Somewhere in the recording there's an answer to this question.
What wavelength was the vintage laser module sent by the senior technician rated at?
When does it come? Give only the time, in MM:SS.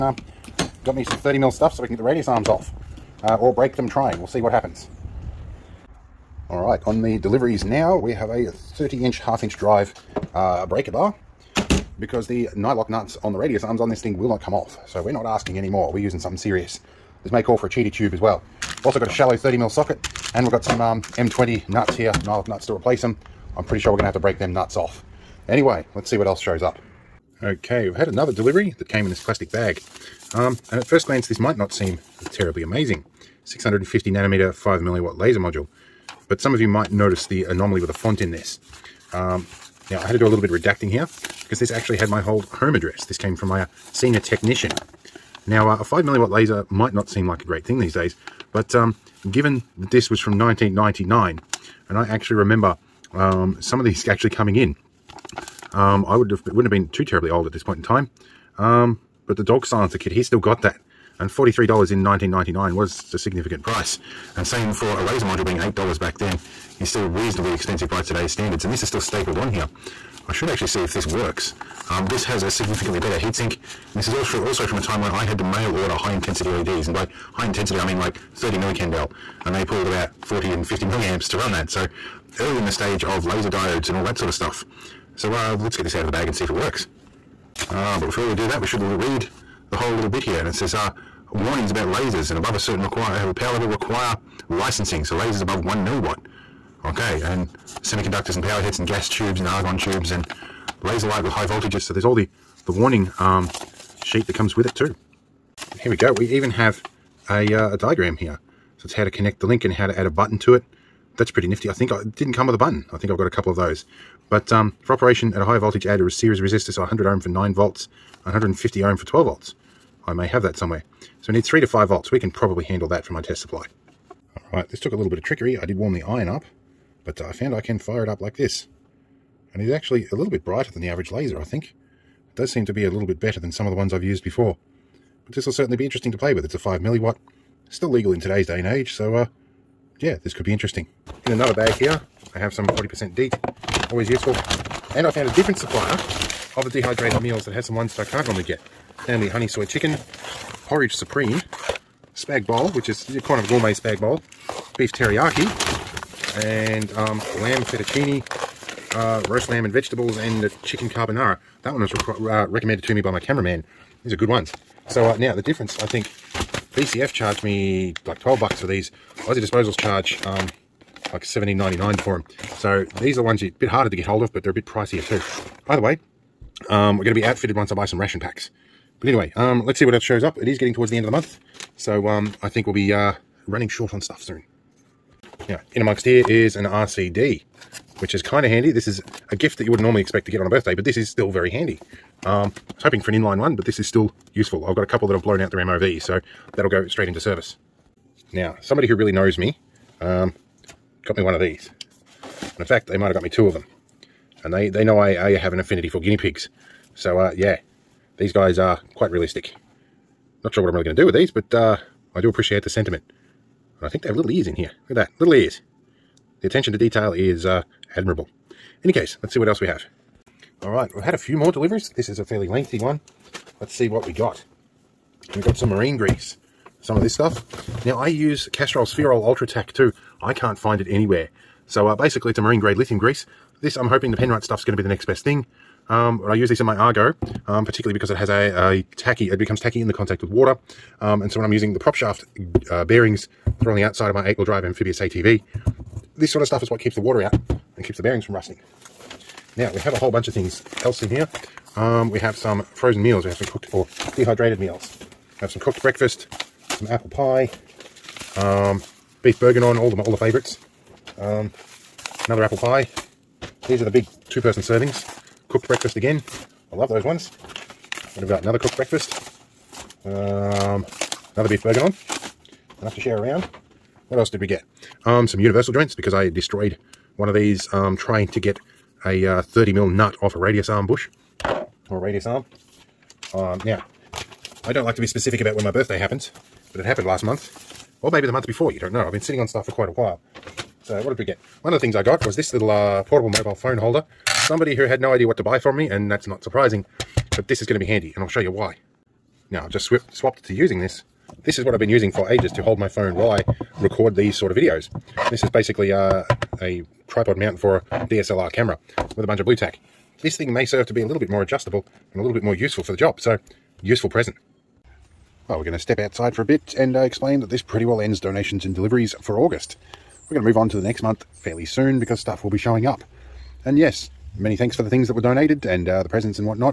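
00:33.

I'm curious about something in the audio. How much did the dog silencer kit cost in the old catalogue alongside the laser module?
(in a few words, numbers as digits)
$43.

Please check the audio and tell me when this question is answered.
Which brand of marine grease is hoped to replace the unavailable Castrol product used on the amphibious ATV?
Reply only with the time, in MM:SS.
03:54.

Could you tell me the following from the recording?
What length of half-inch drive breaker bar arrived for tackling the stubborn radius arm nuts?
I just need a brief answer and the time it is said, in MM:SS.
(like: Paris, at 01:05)
30 inch, at 00:08.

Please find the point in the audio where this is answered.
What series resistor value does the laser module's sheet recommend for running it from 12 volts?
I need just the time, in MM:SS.
01:58.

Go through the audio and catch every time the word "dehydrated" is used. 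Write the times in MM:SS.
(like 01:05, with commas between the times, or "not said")
02:26, 04:14.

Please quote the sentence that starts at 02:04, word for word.
Alright, this took a little bit of trickery.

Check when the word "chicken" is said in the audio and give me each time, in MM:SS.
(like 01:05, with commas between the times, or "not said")
02:29, 02:40.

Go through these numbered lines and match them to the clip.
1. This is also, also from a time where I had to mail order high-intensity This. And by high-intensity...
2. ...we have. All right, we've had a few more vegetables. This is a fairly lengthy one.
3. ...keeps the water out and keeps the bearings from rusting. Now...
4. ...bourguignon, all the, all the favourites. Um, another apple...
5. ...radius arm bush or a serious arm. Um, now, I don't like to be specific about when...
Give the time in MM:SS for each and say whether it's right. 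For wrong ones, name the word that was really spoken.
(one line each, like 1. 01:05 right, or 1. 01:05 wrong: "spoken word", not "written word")
1. 01:13 wrong: "LEDs", not "This"
2. 03:39 wrong: "deliveries", not "vegetables"
3. 04:06 right
4. 04:19 right
5. 04:40 wrong: "radius", not "serious".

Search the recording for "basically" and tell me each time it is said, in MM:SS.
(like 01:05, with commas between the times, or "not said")
03:51, 05:05.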